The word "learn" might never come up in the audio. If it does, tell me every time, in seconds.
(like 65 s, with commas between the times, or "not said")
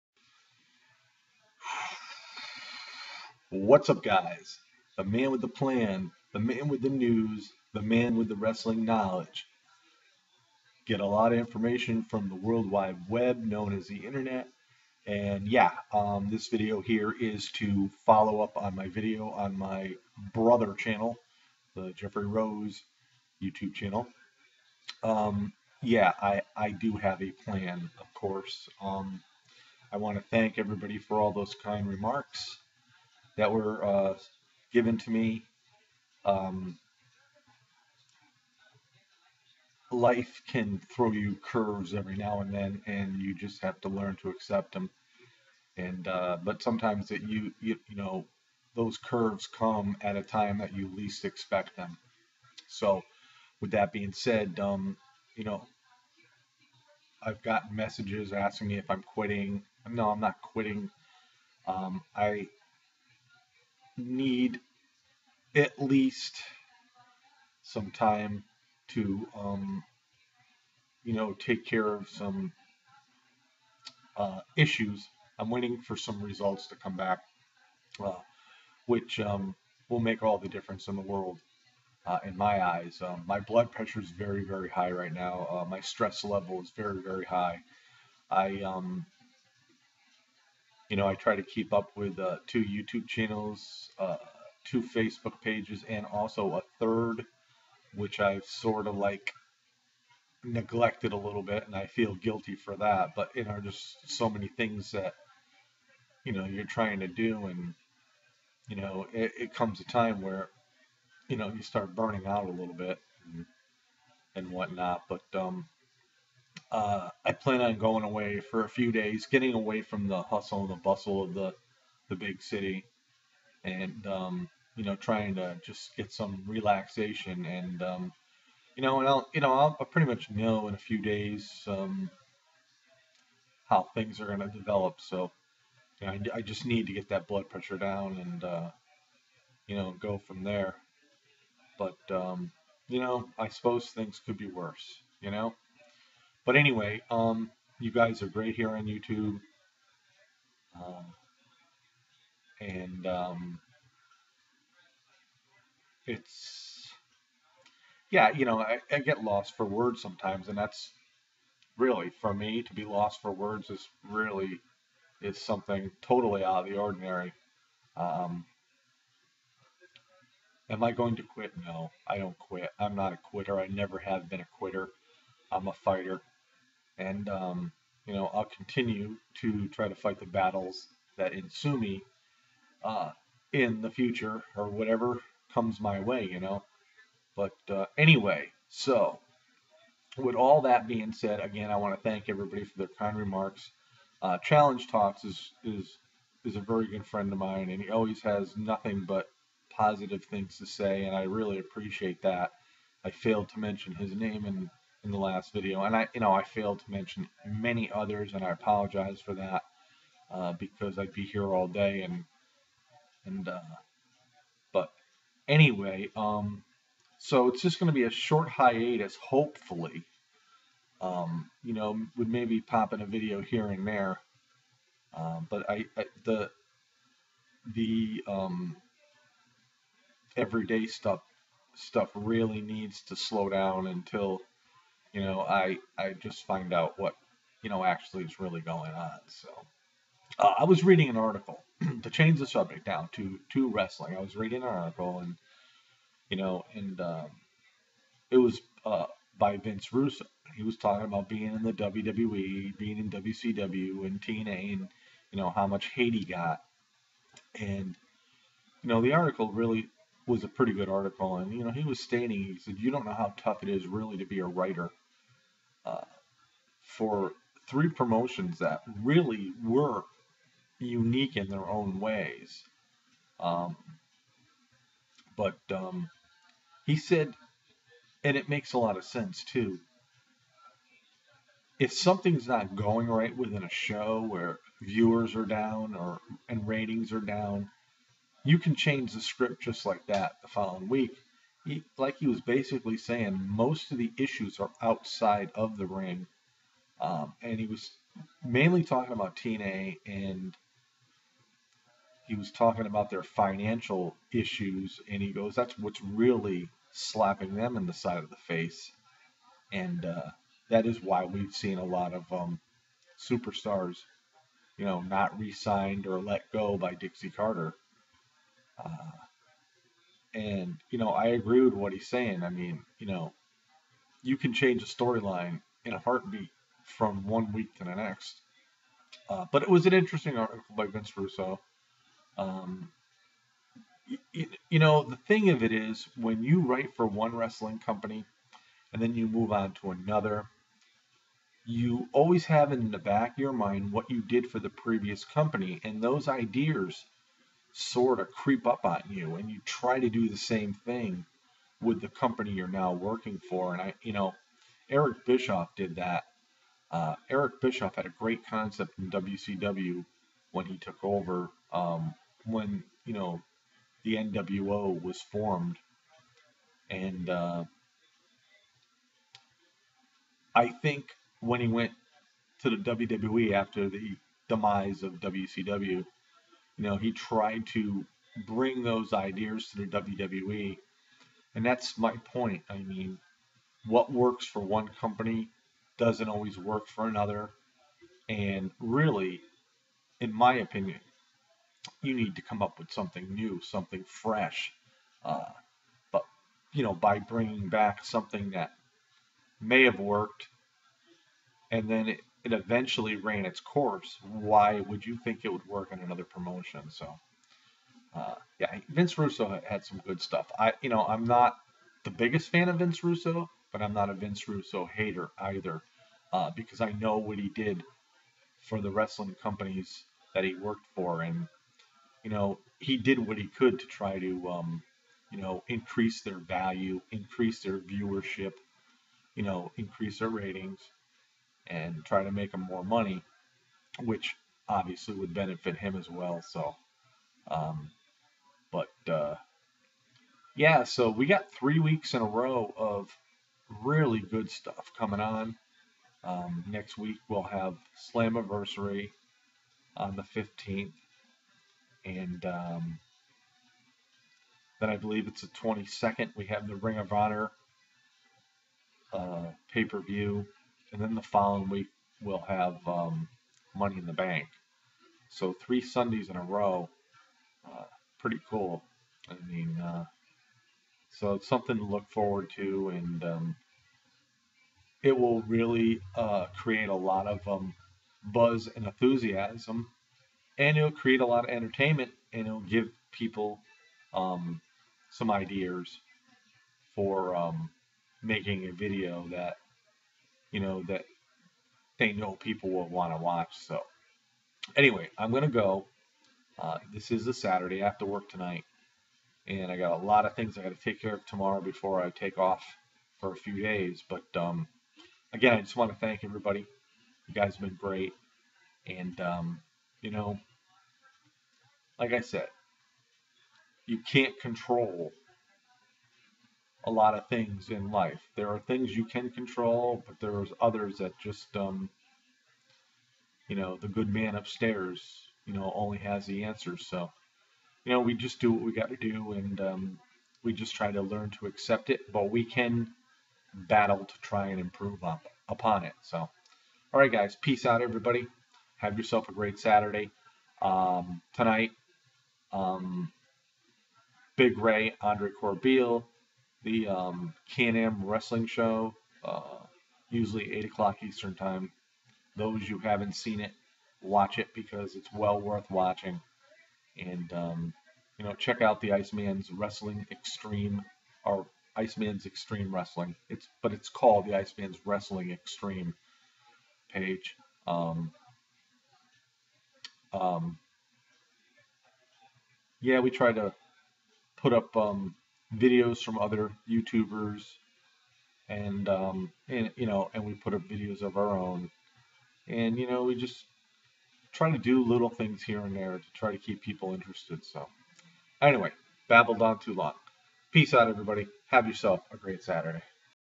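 43 s, 531 s.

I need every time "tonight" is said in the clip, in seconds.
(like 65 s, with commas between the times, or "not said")
498 s, 541 s.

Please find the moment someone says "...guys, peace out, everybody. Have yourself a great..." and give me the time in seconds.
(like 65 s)
537 s.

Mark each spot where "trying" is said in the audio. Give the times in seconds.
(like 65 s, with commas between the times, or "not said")
106 s, 124 s.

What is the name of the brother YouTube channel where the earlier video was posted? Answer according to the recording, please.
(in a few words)
Jeffrey Rose.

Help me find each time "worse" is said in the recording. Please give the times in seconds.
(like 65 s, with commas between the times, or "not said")
144 s.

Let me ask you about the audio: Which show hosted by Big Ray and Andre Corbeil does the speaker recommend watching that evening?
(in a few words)
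Can-Am Wrestling Show.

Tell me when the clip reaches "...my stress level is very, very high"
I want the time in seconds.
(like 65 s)
85 s.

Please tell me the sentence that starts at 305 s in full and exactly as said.
And he goes, that's what's really slapping them in the side of the face.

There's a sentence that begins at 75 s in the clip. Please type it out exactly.
I'm waiting for some results to come back, uh, which um, will make all the difference in the world.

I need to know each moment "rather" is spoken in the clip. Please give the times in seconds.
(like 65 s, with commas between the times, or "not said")
not said.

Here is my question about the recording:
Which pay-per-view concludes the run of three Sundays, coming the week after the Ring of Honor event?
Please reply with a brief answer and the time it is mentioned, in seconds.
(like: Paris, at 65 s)
Money in the Bank, at 463 s.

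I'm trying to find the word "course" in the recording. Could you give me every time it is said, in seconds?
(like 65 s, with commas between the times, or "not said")
28 s, 403 s.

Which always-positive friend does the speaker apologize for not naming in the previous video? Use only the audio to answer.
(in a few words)
Challenge Talks.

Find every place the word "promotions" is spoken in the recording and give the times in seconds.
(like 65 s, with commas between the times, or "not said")
267 s, 406 s.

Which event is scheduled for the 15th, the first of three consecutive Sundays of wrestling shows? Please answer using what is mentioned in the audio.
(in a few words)
Slammiversary.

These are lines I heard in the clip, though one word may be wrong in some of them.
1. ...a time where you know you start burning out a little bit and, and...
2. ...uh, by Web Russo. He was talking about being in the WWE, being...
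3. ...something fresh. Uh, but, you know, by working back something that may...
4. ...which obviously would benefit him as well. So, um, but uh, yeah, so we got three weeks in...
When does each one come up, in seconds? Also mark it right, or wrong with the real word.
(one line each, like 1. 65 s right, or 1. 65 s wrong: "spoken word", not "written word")
1. 109 s right
2. 248 s wrong: "Vince", not "Web"
3. 393 s wrong: "bringing", not "working"
4. 434 s right.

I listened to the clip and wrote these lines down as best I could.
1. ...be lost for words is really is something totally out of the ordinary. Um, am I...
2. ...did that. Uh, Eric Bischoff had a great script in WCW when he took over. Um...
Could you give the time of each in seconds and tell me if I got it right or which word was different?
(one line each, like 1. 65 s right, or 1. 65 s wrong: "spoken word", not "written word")
1. 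162 s right
2. 355 s wrong: "concept", not "script".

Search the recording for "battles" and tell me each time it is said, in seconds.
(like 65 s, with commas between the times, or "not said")
180 s, 533 s.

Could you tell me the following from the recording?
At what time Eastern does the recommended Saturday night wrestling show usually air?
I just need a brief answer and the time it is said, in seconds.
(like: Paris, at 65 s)
8 o'clock, at 550 s.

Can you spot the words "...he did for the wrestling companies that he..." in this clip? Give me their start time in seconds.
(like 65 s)
417 s.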